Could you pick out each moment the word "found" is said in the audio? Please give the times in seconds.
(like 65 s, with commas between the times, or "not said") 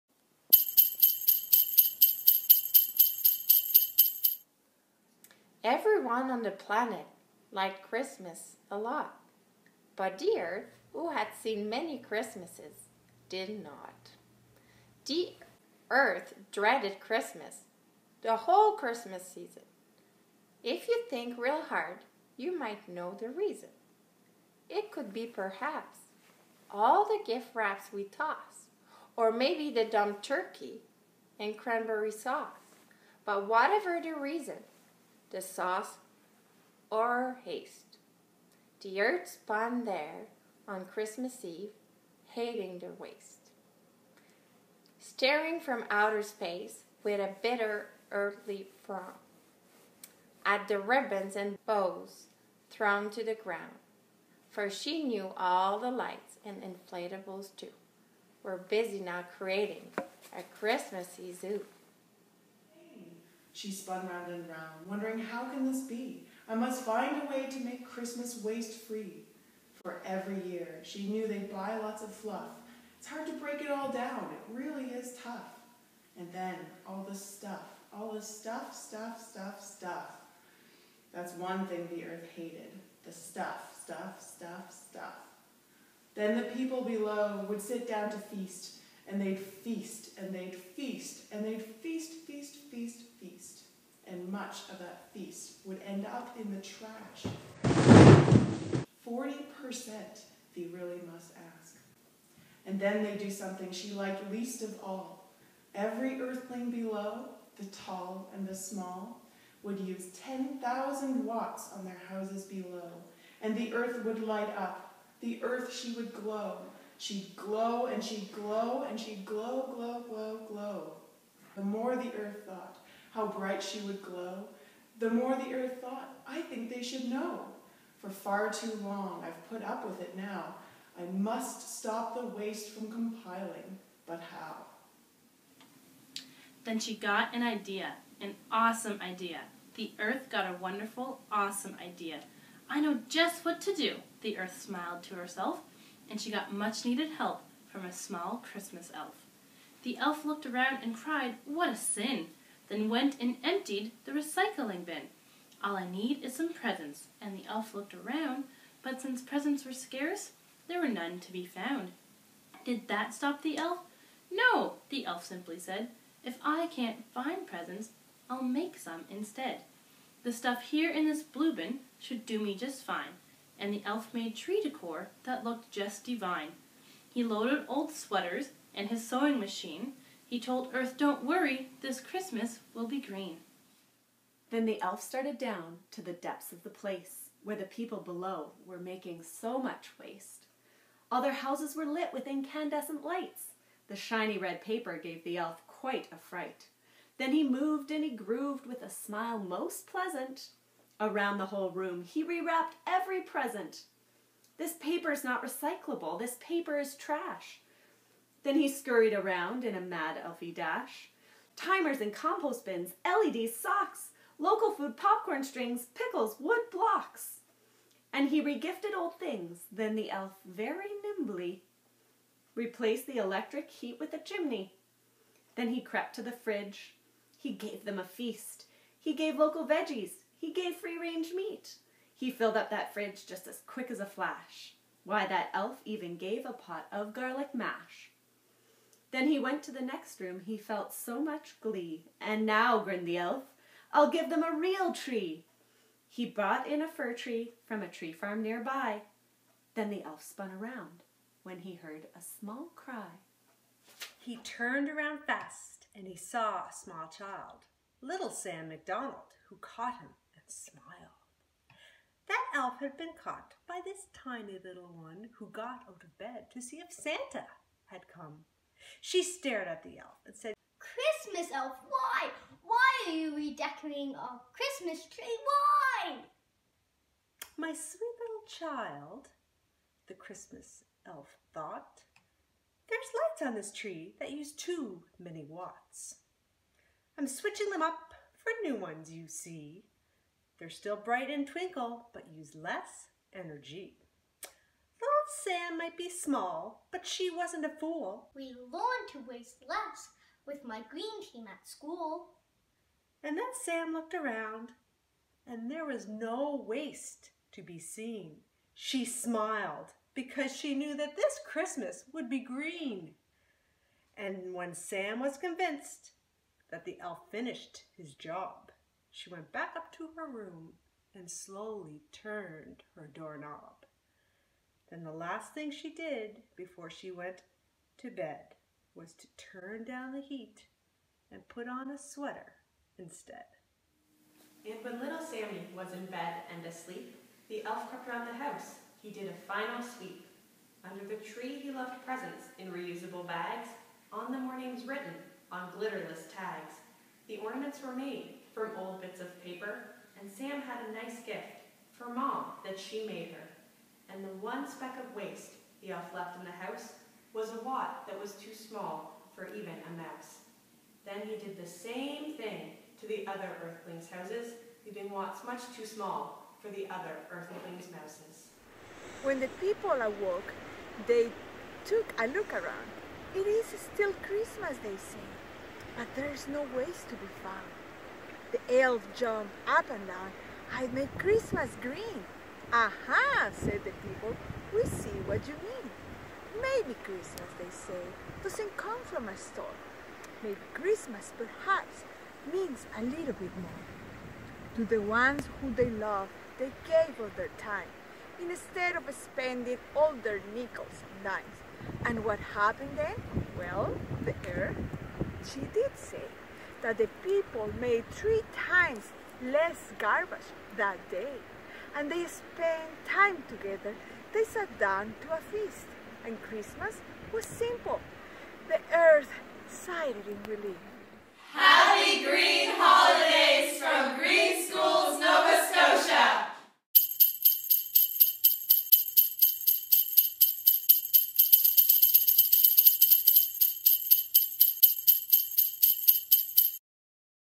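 161 s, 377 s.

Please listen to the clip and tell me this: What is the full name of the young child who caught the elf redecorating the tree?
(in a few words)
Sam MacDonald.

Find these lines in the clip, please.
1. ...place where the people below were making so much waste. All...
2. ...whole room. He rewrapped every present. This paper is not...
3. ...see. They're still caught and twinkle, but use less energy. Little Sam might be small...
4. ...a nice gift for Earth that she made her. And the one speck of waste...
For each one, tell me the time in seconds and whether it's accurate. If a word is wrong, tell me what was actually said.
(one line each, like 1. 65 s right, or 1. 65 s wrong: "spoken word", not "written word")
1. 186 s right
2. 201 s right
3. 289 s wrong: "bright", not "caught"
4. 350 s wrong: "Mom", not "Earth".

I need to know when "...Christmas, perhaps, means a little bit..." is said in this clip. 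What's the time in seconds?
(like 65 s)
390 s.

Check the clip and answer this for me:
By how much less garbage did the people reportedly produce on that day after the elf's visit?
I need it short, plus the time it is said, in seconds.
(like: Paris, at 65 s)
3 times less, at 408 s.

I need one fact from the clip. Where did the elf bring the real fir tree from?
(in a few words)
a tree farm nearby.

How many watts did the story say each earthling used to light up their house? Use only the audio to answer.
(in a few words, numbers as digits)
10,000.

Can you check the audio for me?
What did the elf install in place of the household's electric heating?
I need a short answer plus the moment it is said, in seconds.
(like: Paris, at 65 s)
a chimney, at 224 s.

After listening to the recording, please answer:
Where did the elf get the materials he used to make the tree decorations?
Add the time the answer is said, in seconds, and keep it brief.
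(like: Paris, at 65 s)
the recycling bin, at 154 s.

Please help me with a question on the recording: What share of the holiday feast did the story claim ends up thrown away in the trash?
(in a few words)
40%.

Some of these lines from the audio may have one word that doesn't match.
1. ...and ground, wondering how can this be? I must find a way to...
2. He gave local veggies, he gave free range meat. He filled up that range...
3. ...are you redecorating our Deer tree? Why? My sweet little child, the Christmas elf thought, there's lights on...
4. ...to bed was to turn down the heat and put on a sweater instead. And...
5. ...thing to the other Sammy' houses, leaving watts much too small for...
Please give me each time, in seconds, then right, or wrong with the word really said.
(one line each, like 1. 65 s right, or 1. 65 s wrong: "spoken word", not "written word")
1. 64 s wrong: "round", not "ground"
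2. 228 s wrong: "fridge", not "range"
3. 273 s wrong: "Christmas", not "Deer"
4. 327 s right
5. 362 s wrong: "Earthlings", not "Sammy".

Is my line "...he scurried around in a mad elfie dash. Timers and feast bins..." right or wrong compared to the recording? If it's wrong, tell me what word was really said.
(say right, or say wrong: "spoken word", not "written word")
wrong: "compost", not "feast".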